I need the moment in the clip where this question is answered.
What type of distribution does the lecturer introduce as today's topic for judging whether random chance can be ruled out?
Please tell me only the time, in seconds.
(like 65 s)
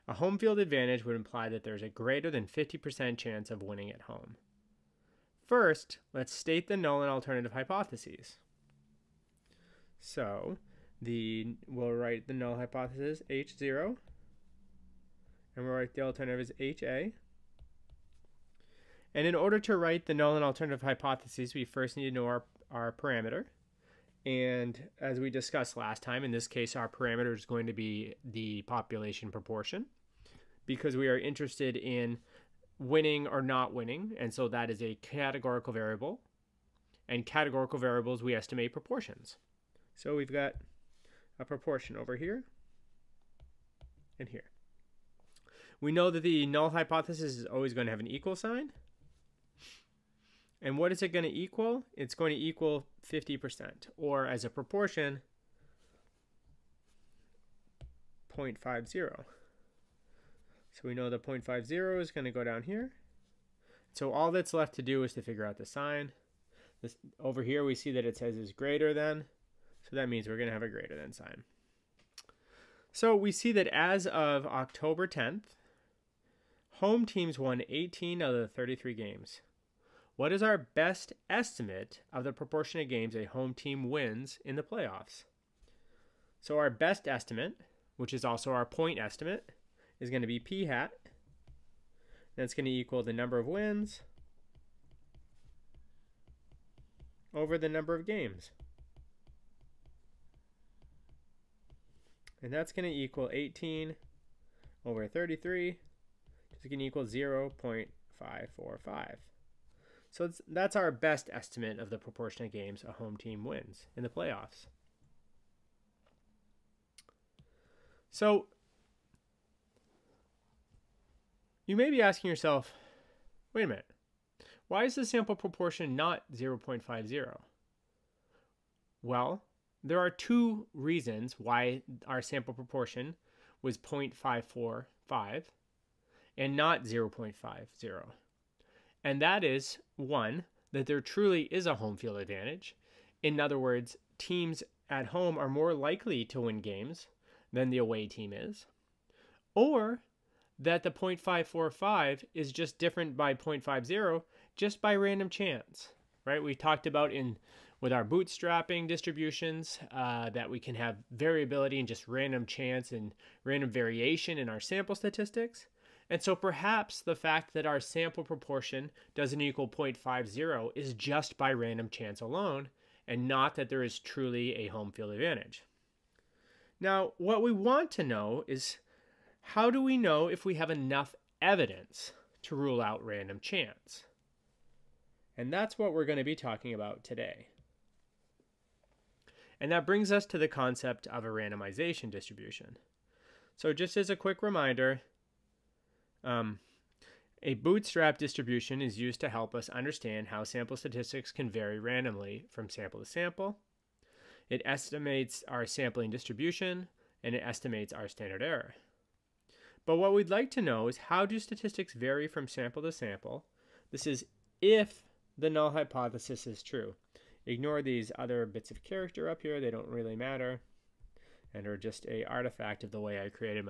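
191 s.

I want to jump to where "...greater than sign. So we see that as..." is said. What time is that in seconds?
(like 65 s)
70 s.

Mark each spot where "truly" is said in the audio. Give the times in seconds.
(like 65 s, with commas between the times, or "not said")
141 s, 173 s.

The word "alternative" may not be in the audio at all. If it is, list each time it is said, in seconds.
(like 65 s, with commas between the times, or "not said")
7 s, 16 s, 20 s.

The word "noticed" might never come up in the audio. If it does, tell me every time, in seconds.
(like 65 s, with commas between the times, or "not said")
not said.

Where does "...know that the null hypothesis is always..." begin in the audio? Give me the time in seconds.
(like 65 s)
45 s.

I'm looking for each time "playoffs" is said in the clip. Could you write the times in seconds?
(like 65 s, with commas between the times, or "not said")
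84 s, 114 s.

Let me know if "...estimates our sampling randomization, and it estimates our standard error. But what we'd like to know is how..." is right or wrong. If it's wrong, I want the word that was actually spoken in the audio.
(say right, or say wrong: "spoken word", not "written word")
wrong: "distribution", not "randomization".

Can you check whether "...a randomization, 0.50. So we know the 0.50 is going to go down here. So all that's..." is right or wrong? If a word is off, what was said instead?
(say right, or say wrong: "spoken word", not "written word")
wrong: "proportion", not "randomization".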